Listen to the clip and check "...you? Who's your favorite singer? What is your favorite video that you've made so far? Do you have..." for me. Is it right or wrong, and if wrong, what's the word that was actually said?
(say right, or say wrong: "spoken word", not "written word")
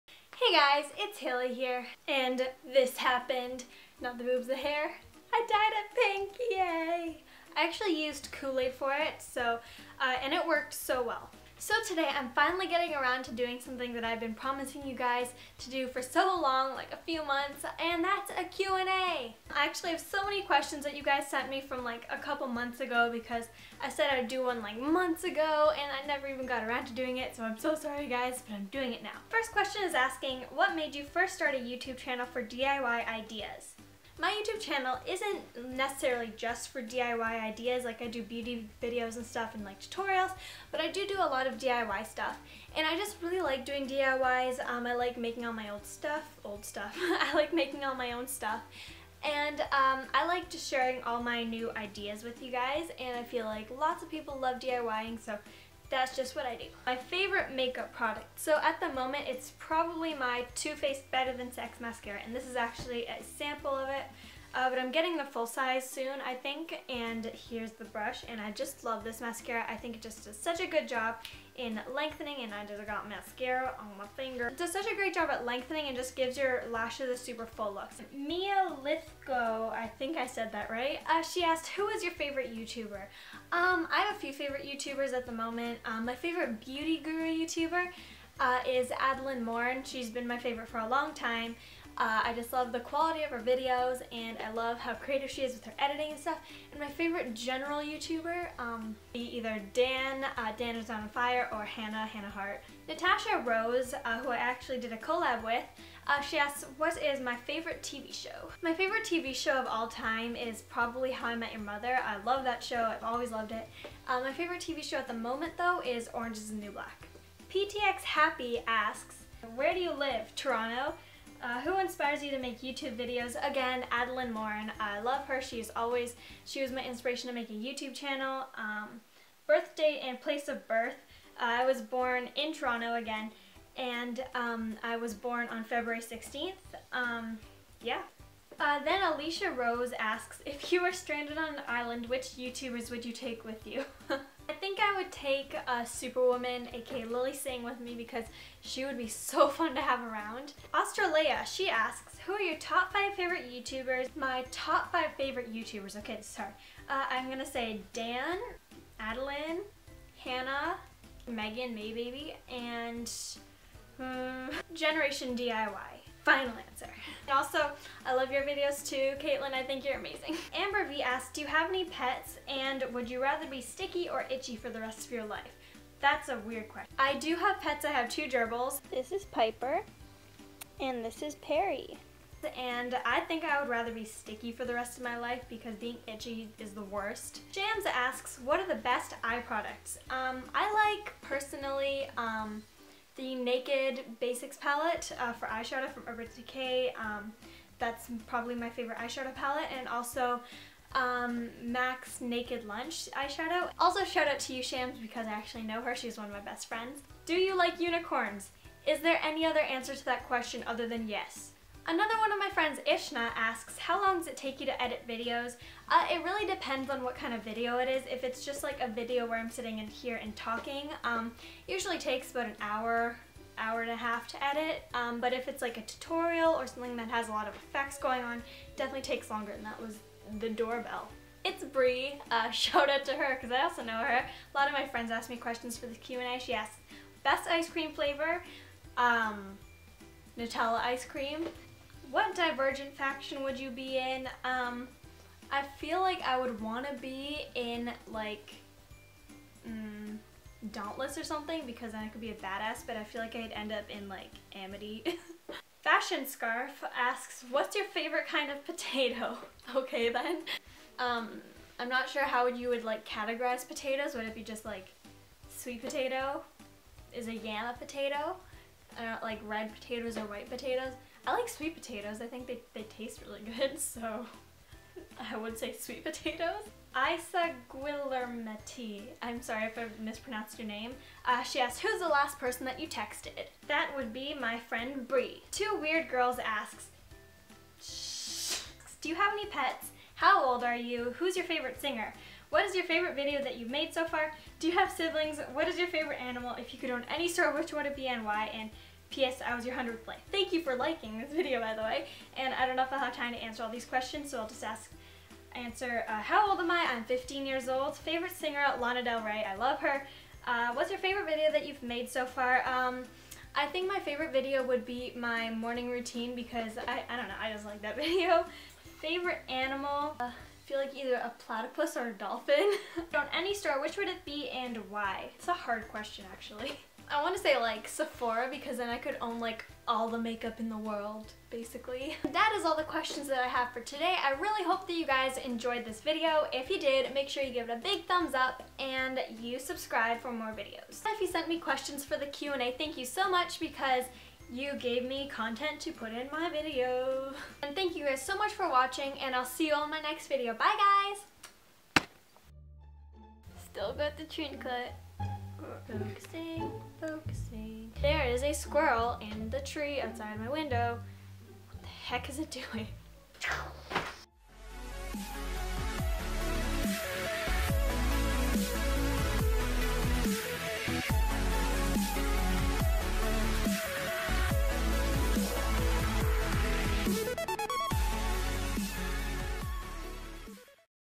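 right.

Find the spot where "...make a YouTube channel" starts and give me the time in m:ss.
2:07.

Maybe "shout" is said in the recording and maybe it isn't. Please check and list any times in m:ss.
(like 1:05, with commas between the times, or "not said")
3:24, 3:52.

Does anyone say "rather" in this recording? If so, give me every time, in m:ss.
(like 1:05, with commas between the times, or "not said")
2:53, 3:03.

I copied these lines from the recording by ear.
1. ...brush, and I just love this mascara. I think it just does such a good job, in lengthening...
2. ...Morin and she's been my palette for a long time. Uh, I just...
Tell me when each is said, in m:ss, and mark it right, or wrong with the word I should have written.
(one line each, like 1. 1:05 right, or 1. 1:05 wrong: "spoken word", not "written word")
1. 1:07 right
2. 1:29 wrong: "favorite", not "palette".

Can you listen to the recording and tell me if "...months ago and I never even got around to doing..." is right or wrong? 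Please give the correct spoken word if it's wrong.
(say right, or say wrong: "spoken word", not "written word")
right.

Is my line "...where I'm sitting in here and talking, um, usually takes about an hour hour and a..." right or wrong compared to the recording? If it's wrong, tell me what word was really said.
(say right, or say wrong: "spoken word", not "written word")
right.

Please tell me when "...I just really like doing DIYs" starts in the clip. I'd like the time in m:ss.
0:42.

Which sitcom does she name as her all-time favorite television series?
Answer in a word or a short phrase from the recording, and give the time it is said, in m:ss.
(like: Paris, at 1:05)
How I Met Your Mother, at 1:51.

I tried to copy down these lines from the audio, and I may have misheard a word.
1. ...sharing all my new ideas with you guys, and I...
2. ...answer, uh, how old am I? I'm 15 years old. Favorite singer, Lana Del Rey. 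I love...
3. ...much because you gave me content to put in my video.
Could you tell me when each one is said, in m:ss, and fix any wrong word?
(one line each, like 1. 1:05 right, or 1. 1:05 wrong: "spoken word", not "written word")
1. 0:50 right
2. 5:05 right
3. 5:43 right.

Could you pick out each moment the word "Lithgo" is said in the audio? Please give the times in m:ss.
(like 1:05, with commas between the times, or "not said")
1:18.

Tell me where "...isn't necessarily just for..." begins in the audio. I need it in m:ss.
0:35.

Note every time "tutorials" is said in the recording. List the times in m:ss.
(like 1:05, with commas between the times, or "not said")
0:39, 3:45.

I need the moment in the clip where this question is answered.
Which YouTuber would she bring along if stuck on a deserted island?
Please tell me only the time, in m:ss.
2:27.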